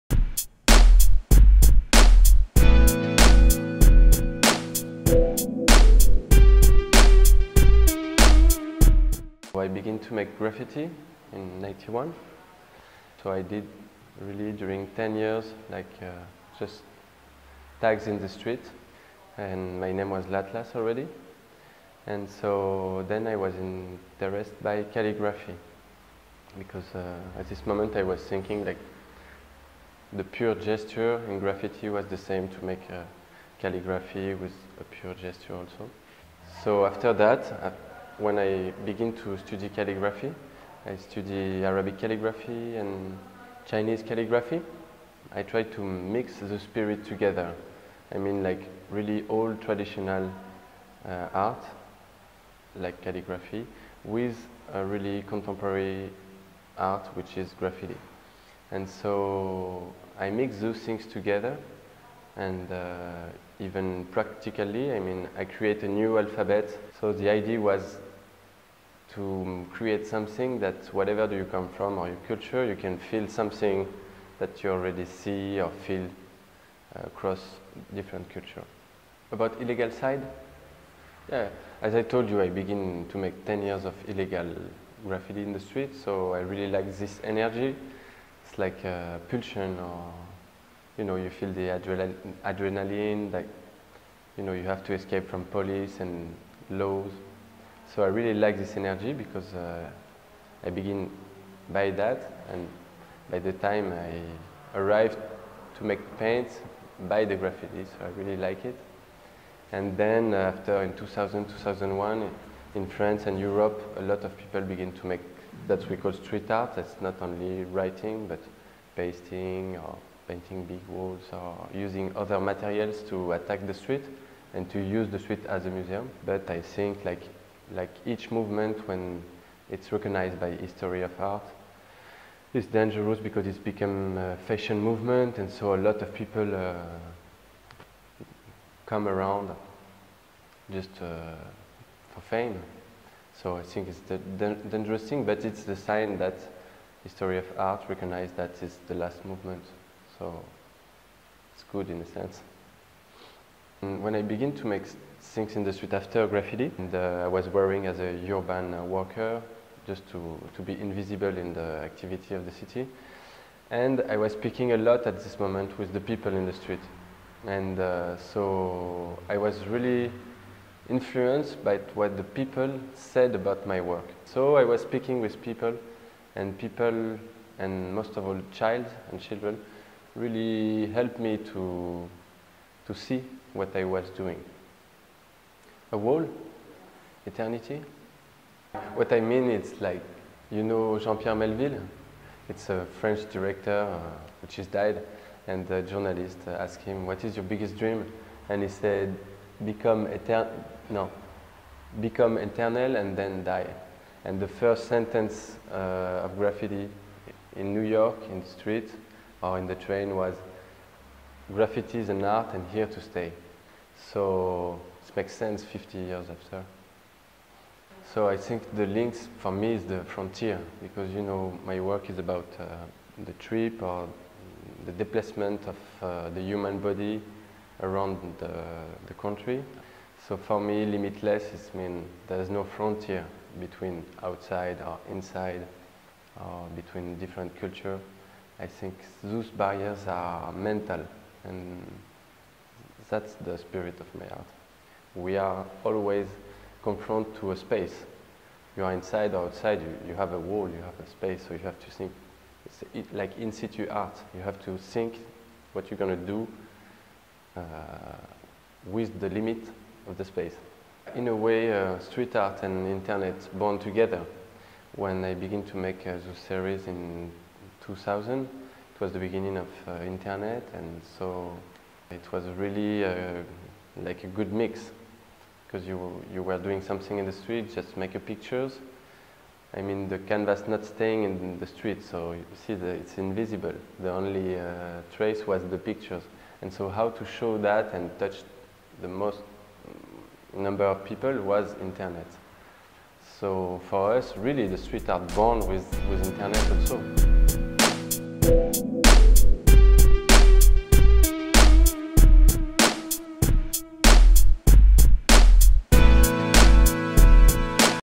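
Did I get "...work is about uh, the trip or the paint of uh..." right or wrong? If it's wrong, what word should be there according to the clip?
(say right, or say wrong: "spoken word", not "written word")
wrong: "displacement", not "paint".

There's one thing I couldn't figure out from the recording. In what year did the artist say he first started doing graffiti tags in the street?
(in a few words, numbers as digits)
1991.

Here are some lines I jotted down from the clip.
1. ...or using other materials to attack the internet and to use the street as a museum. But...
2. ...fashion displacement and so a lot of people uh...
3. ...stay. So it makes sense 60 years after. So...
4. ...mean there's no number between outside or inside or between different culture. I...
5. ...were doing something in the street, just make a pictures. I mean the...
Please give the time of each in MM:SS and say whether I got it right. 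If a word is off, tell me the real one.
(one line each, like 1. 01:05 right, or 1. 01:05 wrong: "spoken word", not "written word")
1. 02:01 wrong: "street", not "internet"
2. 02:14 wrong: "movement", not "displacement"
3. 03:33 wrong: "50", not "60"
4. 03:51 wrong: "frontier", not "number"
5. 04:36 right.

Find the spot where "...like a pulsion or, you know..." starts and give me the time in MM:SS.
01:28.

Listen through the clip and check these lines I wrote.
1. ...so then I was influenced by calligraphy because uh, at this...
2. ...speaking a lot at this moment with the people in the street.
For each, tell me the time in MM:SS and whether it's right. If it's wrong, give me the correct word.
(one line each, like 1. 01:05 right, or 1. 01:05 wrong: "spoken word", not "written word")
1. 00:22 wrong: "interested", not "influenced"
2. 02:44 right.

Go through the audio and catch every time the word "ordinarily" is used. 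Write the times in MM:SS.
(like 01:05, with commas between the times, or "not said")
not said.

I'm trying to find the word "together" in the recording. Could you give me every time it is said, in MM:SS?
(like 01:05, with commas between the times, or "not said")
00:47, 01:01, 04:23.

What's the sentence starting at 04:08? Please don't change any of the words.
You are inside or outside, you, you have a wall, you have a space, so you have to think.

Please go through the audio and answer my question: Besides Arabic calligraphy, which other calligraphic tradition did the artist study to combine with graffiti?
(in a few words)
Chinese calligraphy.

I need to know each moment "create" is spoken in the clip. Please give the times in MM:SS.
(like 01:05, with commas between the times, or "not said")
01:05, 01:09.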